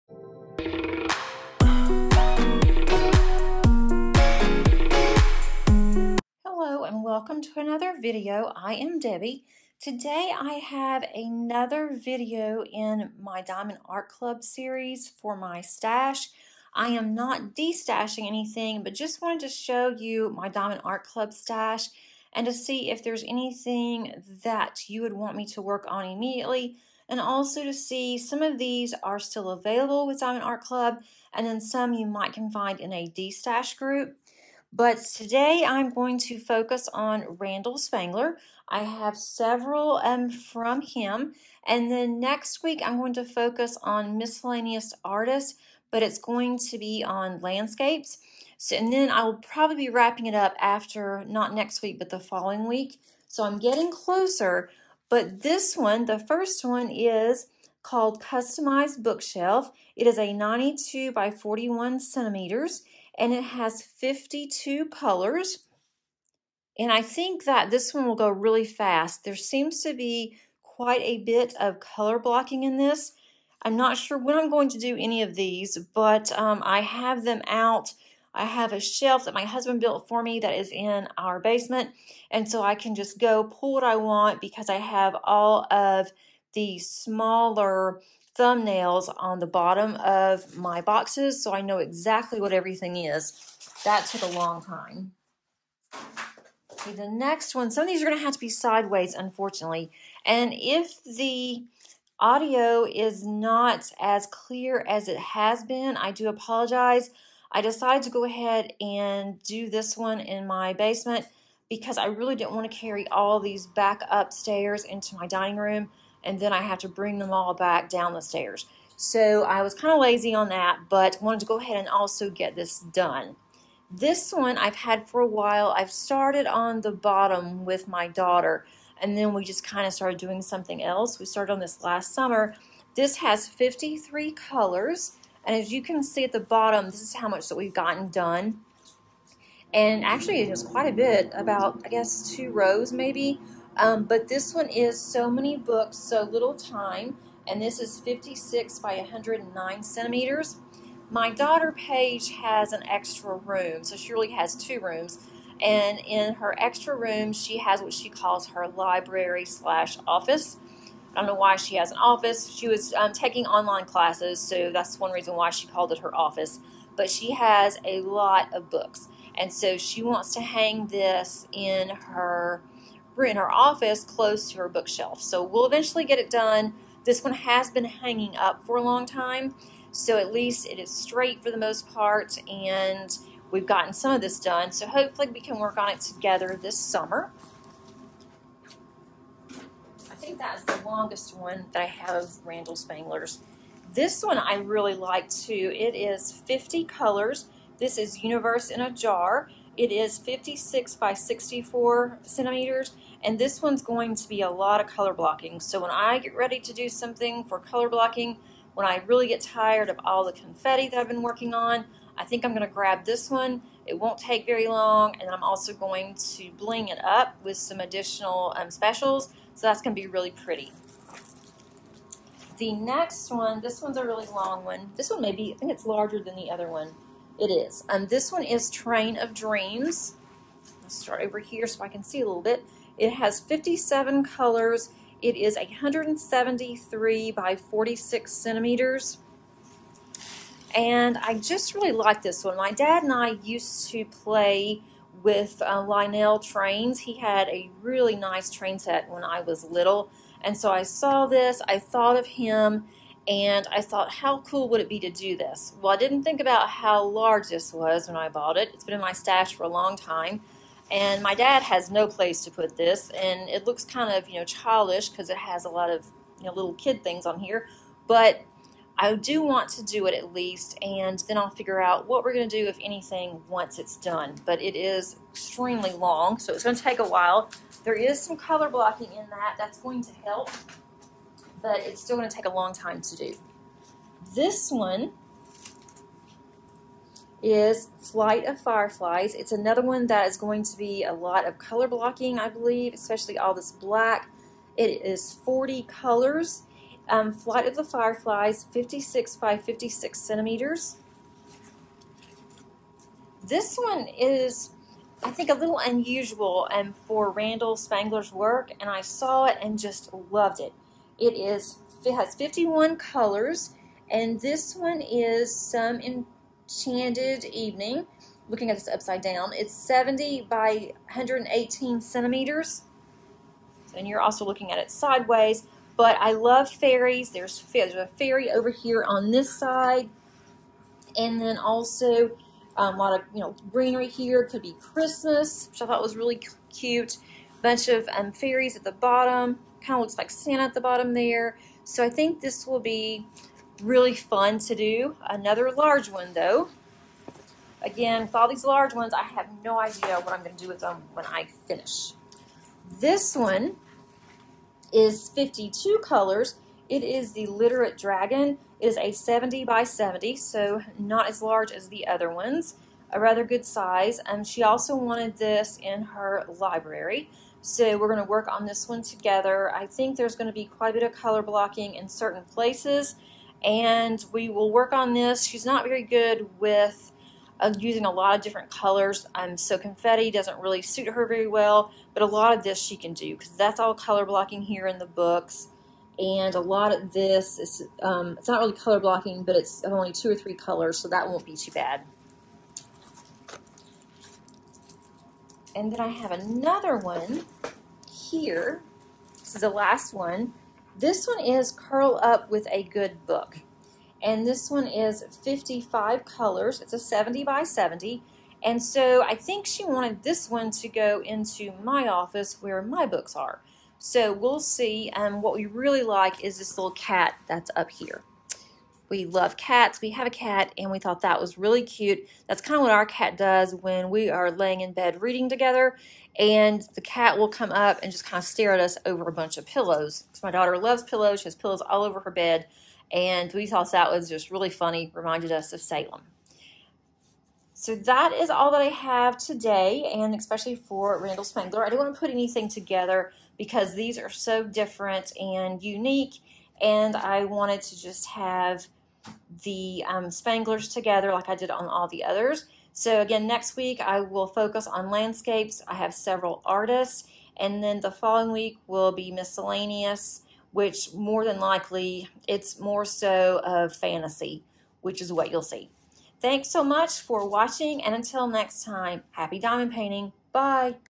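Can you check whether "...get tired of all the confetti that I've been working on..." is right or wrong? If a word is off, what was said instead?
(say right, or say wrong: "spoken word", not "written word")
right.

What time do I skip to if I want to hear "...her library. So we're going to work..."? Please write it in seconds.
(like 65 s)
366 s.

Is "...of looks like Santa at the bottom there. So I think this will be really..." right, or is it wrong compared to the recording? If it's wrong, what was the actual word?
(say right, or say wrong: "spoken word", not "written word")
right.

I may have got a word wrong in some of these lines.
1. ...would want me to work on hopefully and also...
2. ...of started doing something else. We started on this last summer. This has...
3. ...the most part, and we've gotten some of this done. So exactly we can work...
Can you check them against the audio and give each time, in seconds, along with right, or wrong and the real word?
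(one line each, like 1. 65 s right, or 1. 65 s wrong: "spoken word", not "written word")
1. 25 s wrong: "immediately", not "hopefully"
2. 129 s right
3. 181 s wrong: "hopefully", not "exactly".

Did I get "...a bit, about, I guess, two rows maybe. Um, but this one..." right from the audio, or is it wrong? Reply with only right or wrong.
right.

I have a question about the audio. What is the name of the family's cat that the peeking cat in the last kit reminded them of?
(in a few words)
Salem.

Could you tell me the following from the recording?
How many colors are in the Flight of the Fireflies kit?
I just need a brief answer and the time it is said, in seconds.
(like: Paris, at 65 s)
40, at 295 s.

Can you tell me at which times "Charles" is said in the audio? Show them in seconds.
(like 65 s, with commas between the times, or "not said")
not said.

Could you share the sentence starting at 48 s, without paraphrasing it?
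So, and then I will probably be wrapping it up after, not next week, but the following week.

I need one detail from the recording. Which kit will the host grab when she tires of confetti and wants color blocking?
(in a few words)
Universe in a Jar.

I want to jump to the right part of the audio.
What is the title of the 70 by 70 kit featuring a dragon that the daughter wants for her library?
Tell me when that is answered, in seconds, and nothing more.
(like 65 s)
357 s.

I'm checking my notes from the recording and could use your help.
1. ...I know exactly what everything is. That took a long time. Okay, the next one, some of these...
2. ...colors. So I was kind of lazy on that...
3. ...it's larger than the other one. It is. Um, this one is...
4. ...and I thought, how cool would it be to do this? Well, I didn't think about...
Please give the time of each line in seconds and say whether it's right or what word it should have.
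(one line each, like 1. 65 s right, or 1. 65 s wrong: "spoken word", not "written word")
1. 91 s right
2. 118 s wrong: "stairs", not "colors"
3. 225 s right
4. 253 s right.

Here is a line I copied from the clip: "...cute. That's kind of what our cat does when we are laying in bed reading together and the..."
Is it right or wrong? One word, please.
right.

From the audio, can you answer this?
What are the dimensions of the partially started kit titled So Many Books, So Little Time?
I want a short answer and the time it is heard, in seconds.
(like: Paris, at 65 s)
56 by 109 centimeters, at 148 s.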